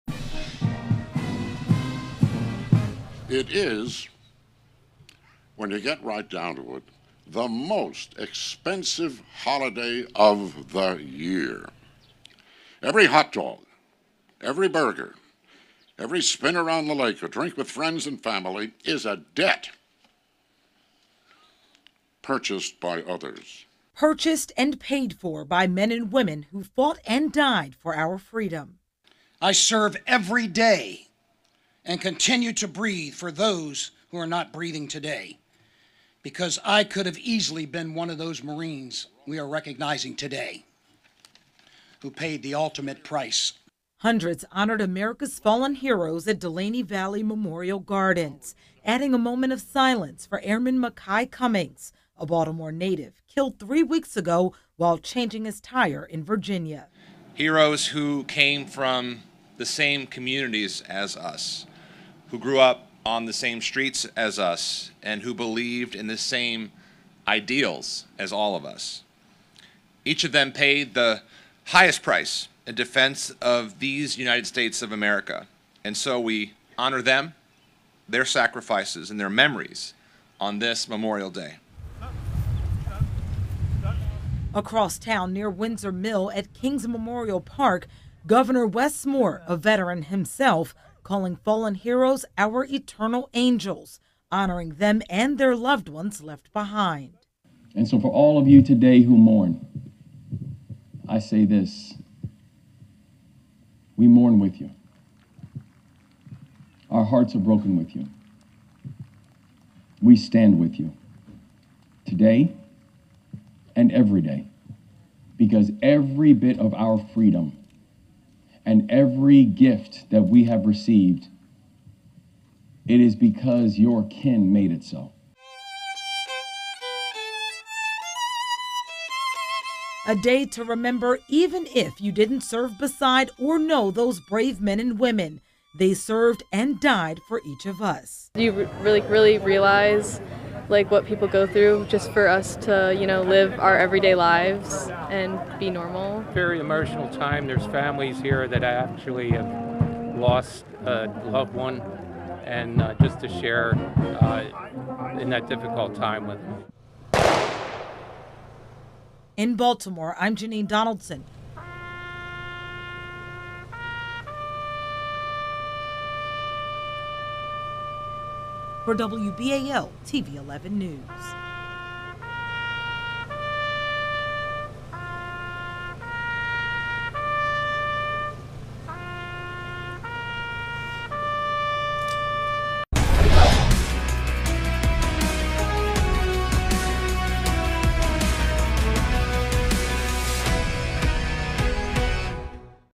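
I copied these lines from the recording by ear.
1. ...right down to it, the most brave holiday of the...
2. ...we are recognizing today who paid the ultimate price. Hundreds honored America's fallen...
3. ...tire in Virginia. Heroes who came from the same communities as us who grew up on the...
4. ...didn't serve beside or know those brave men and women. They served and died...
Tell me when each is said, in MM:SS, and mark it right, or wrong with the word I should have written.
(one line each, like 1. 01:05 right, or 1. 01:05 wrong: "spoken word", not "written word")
1. 00:06 wrong: "expensive", not "brave"
2. 00:39 right
3. 00:55 right
4. 02:12 right.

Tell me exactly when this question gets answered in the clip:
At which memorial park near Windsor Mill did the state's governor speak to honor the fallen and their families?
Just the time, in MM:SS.
01:26.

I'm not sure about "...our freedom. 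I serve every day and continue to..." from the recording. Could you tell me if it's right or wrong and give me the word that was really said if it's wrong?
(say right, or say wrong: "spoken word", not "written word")
right.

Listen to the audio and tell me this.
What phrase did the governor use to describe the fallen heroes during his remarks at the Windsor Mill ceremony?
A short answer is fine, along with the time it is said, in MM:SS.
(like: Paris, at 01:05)
Eternal angels, at 01:32.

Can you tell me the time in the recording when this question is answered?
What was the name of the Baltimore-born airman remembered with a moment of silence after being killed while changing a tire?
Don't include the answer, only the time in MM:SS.
00:50.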